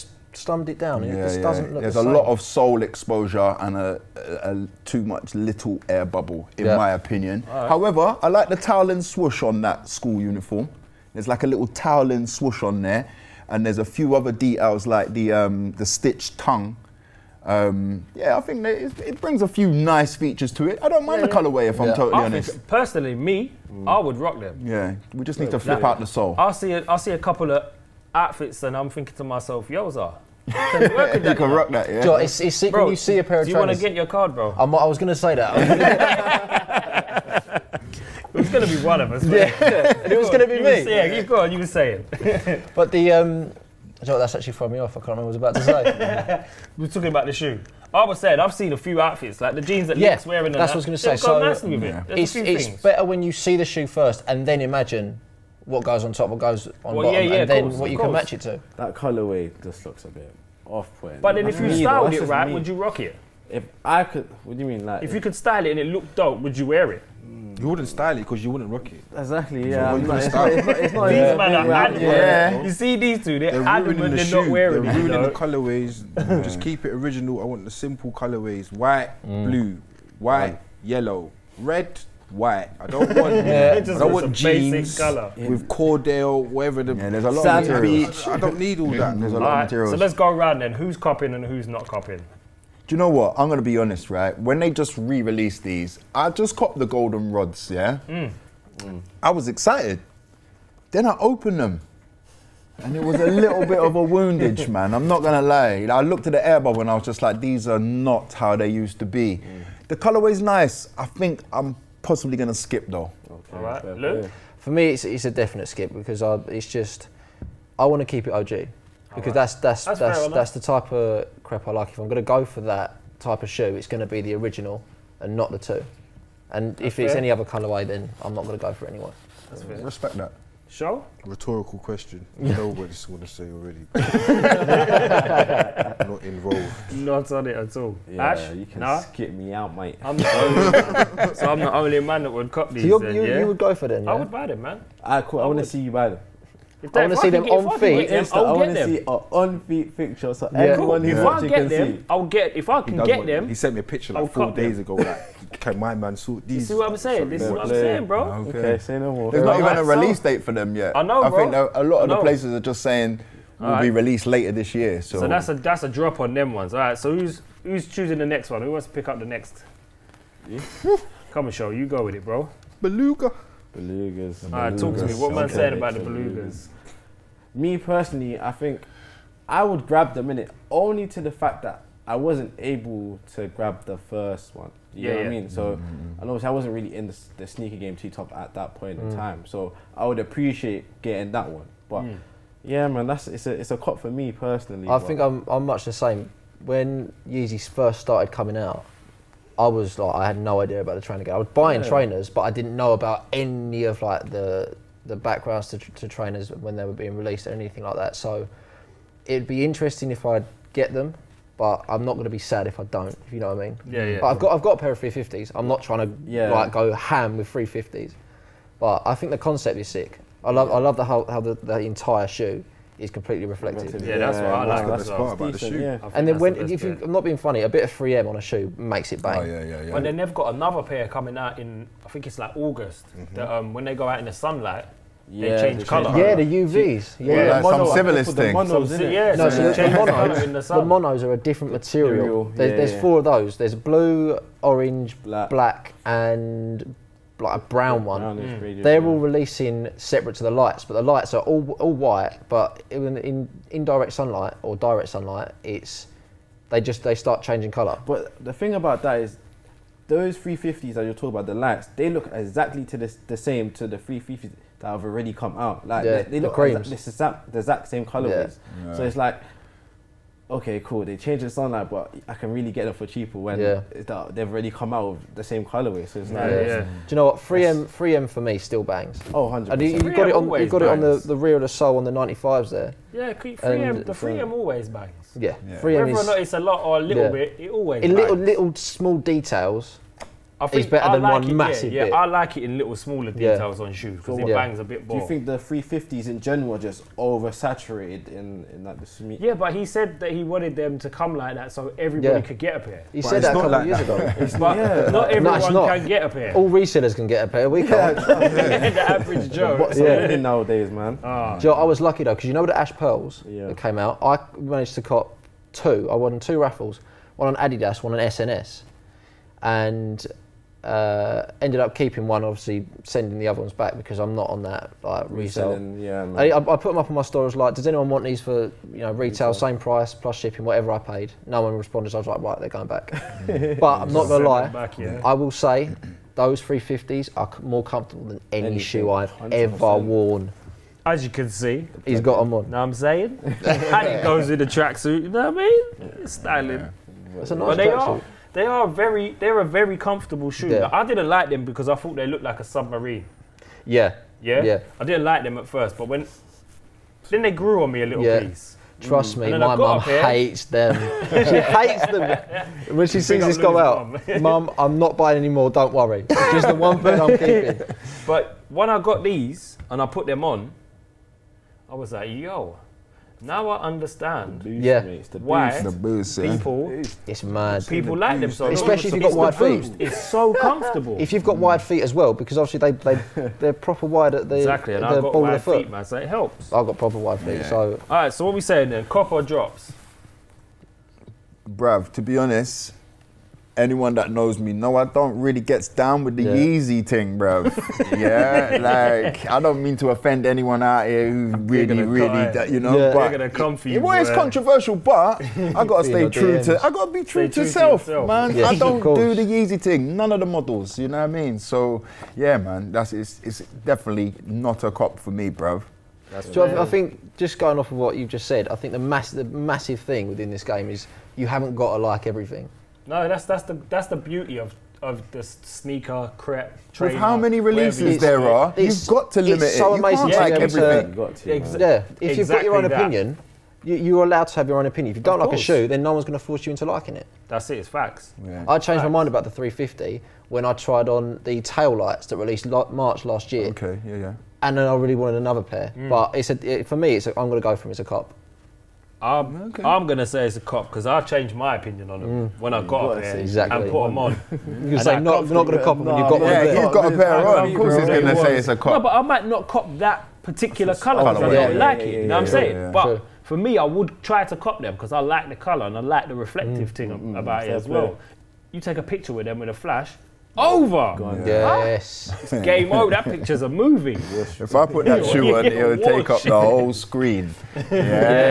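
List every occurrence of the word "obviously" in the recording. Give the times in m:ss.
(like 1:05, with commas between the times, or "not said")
3:06, 5:22, 6:22.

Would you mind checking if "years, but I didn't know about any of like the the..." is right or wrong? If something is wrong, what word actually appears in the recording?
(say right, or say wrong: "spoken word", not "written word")
wrong: "trainers", not "years".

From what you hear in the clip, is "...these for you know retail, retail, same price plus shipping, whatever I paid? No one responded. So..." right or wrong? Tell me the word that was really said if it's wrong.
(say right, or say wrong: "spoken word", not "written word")
right.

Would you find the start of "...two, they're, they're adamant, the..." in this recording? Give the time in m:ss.
1:13.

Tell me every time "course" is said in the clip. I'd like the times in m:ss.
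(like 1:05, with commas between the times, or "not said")
0:57, 7:37.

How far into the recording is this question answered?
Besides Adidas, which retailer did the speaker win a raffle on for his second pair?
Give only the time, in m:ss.
5:18.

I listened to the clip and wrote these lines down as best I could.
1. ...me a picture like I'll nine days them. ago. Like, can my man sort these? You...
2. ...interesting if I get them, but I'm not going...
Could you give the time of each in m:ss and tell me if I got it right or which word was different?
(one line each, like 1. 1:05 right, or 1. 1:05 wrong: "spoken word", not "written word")
1. 2:33 wrong: "four", not "nine"
2. 3:29 right.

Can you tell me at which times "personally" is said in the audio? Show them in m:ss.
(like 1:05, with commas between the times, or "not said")
0:22, 2:57, 3:14.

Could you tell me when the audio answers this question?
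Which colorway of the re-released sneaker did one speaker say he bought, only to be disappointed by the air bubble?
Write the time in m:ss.
1:36.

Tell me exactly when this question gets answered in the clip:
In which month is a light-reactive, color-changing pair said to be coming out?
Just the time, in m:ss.
3:52.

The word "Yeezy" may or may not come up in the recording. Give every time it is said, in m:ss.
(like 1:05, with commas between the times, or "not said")
3:17, 6:36, 6:49.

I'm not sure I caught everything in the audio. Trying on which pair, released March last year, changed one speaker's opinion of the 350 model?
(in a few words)
Tail lights.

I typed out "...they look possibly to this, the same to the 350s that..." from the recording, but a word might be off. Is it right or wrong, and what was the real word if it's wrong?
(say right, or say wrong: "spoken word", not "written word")
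wrong: "exactly", not "possibly".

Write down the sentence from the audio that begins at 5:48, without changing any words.
They are very, they're a very comfortable shoe.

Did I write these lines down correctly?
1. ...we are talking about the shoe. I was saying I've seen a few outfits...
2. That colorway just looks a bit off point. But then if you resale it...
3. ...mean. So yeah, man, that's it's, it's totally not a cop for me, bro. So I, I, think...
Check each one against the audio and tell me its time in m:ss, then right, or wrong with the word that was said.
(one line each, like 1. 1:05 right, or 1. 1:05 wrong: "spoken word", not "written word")
1. 0:46 right
2. 0:58 wrong: "style", not "resale"
3. 6:51 wrong: "definitely", not "totally".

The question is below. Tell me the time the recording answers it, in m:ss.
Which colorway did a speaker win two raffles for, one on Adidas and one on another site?
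5:12.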